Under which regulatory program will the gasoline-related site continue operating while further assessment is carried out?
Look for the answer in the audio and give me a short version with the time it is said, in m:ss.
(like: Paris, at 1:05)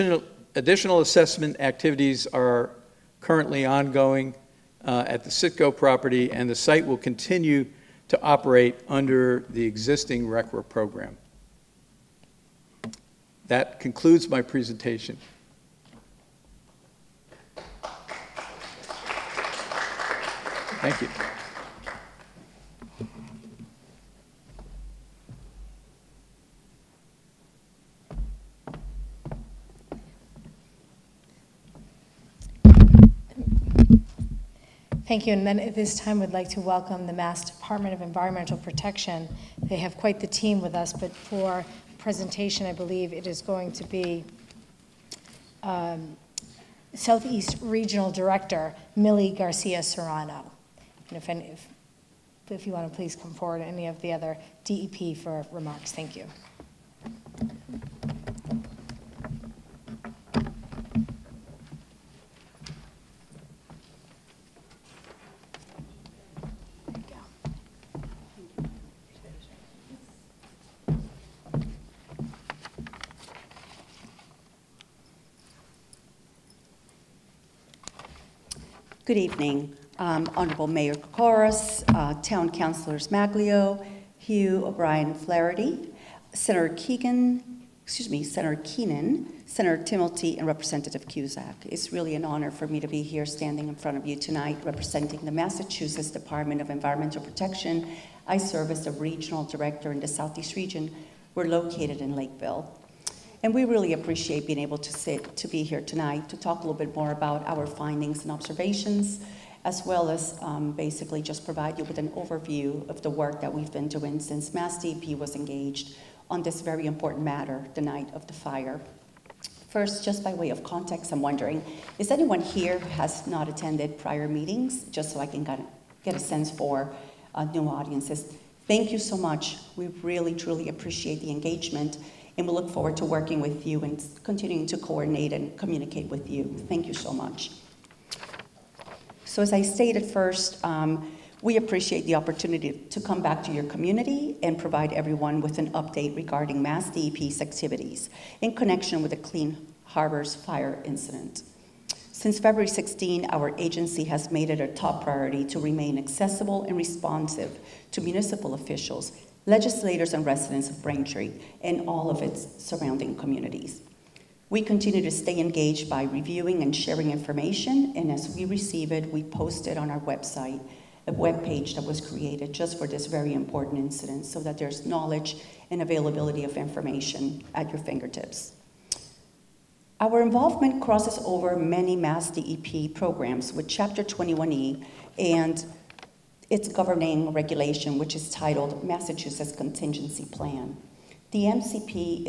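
RCRA, at 0:10.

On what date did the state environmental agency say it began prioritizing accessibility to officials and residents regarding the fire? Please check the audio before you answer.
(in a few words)
February 16.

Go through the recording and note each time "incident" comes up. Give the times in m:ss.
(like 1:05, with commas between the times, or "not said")
2:30, 2:53.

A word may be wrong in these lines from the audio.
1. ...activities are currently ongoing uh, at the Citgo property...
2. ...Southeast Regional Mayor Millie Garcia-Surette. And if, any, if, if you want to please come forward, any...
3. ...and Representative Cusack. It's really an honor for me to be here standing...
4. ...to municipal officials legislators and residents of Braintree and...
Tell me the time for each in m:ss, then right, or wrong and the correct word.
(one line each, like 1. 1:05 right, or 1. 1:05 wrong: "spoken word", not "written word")
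1. 0:01 right
2. 0:46 wrong: "Director", not "Mayor"
3. 1:30 right
4. 2:37 right.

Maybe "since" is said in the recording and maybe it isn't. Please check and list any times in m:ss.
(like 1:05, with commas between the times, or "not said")
1:54, 2:32.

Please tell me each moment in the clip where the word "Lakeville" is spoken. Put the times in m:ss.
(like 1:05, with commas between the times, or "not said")
1:42.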